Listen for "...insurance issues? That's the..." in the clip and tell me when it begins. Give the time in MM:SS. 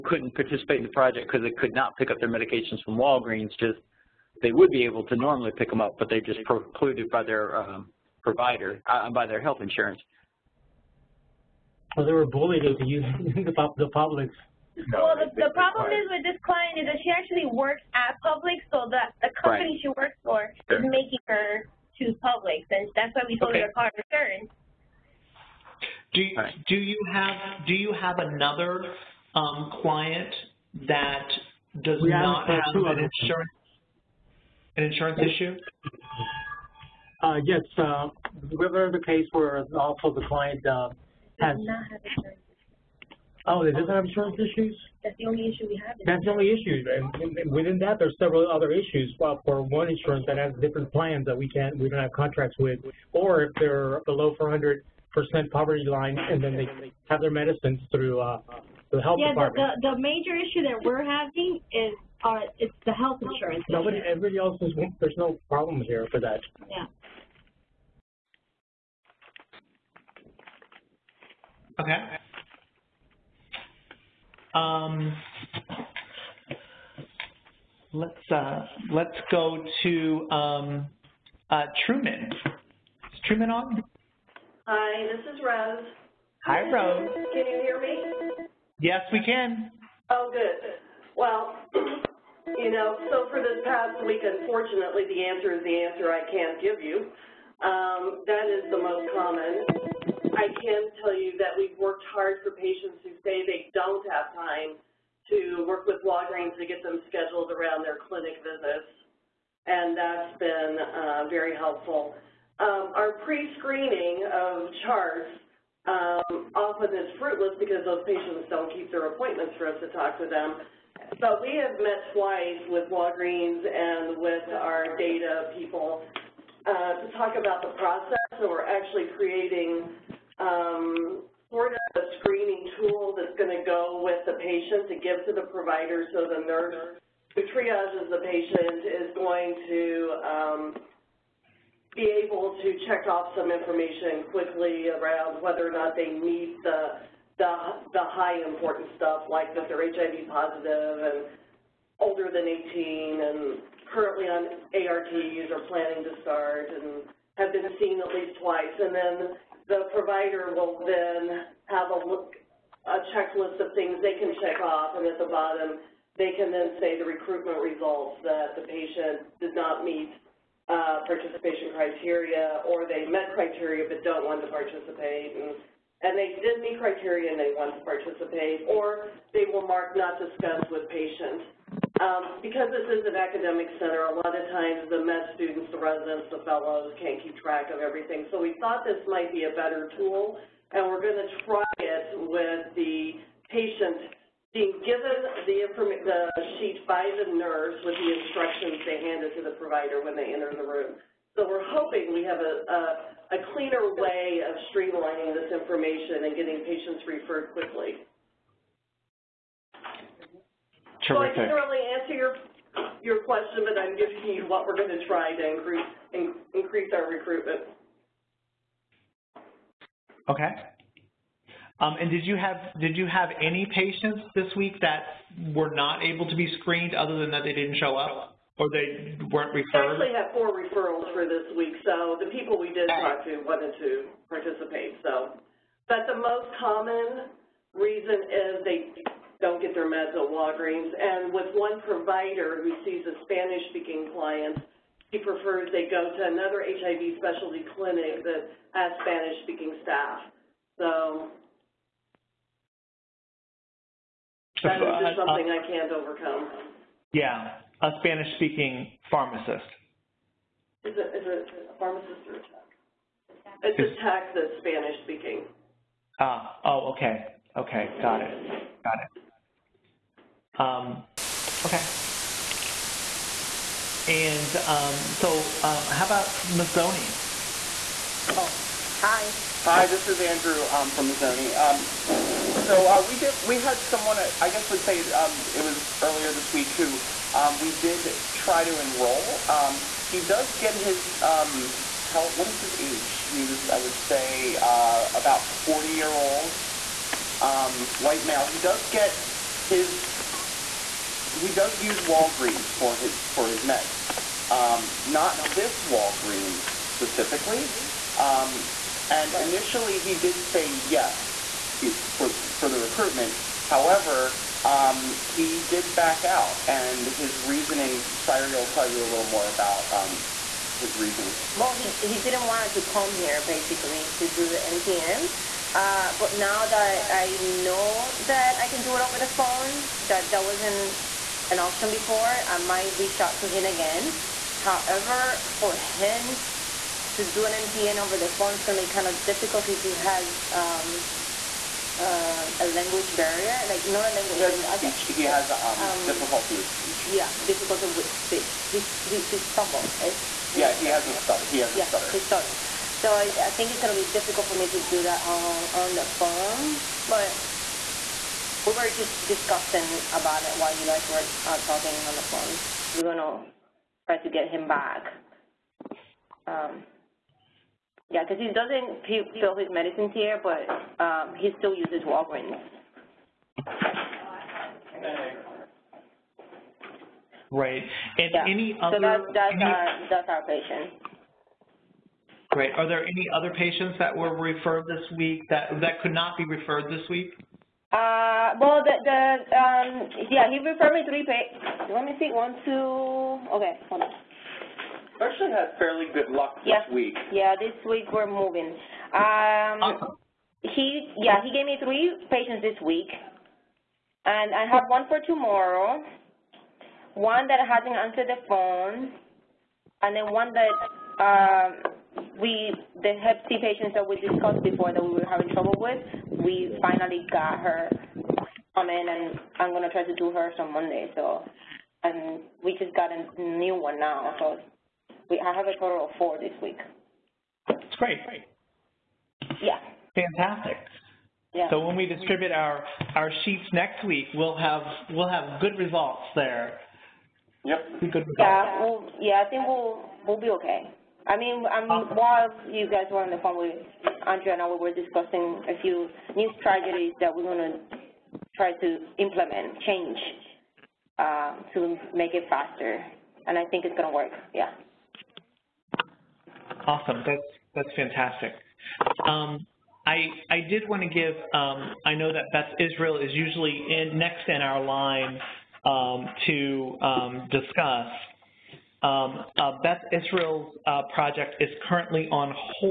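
00:44.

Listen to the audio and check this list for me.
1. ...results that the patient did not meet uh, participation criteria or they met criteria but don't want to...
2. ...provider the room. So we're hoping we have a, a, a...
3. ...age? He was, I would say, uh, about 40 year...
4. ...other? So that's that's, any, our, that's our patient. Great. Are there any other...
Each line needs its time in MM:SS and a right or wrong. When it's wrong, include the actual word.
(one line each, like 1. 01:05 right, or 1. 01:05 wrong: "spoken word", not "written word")
1. 02:47 right
2. 03:20 wrong: "enter", not "provider"
3. 04:52 right
4. 06:18 right.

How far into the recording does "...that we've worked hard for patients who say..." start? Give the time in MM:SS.
01:41.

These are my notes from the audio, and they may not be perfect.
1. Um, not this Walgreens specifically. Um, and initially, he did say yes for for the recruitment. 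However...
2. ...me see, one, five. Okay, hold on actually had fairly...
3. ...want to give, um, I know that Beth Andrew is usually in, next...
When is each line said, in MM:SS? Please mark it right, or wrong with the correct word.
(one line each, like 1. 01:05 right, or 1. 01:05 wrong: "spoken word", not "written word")
1. 05:04 right
2. 06:32 wrong: "two", not "five"
3. 07:40 wrong: "Israel", not "Andrew".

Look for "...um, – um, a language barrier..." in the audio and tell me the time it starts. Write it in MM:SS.
05:40.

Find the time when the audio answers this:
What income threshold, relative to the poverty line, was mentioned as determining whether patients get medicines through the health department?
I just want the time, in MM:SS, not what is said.
00:54.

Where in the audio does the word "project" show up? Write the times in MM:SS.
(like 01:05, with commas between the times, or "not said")
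00:00, 07:51.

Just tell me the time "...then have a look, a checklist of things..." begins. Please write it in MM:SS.
02:40.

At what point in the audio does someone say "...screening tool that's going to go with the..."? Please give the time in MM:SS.
02:12.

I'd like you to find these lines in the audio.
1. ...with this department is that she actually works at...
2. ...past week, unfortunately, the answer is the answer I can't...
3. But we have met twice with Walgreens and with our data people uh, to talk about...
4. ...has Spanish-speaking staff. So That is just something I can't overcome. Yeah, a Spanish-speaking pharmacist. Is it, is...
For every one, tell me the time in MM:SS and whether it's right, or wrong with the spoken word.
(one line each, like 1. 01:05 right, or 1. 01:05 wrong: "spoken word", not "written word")
1. 00:16 wrong: "client", not "department"
2. 01:33 right
3. 02:01 right
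4. 04:08 right.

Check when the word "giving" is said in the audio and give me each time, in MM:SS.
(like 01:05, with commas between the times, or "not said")
03:33.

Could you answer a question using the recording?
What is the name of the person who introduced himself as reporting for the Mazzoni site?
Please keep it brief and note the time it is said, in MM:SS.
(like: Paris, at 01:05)
Andrew, at 04:40.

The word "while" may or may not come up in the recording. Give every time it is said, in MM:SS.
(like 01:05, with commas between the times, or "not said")
06:00, 07:22.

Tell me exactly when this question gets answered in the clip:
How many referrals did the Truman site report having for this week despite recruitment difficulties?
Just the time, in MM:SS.
03:50.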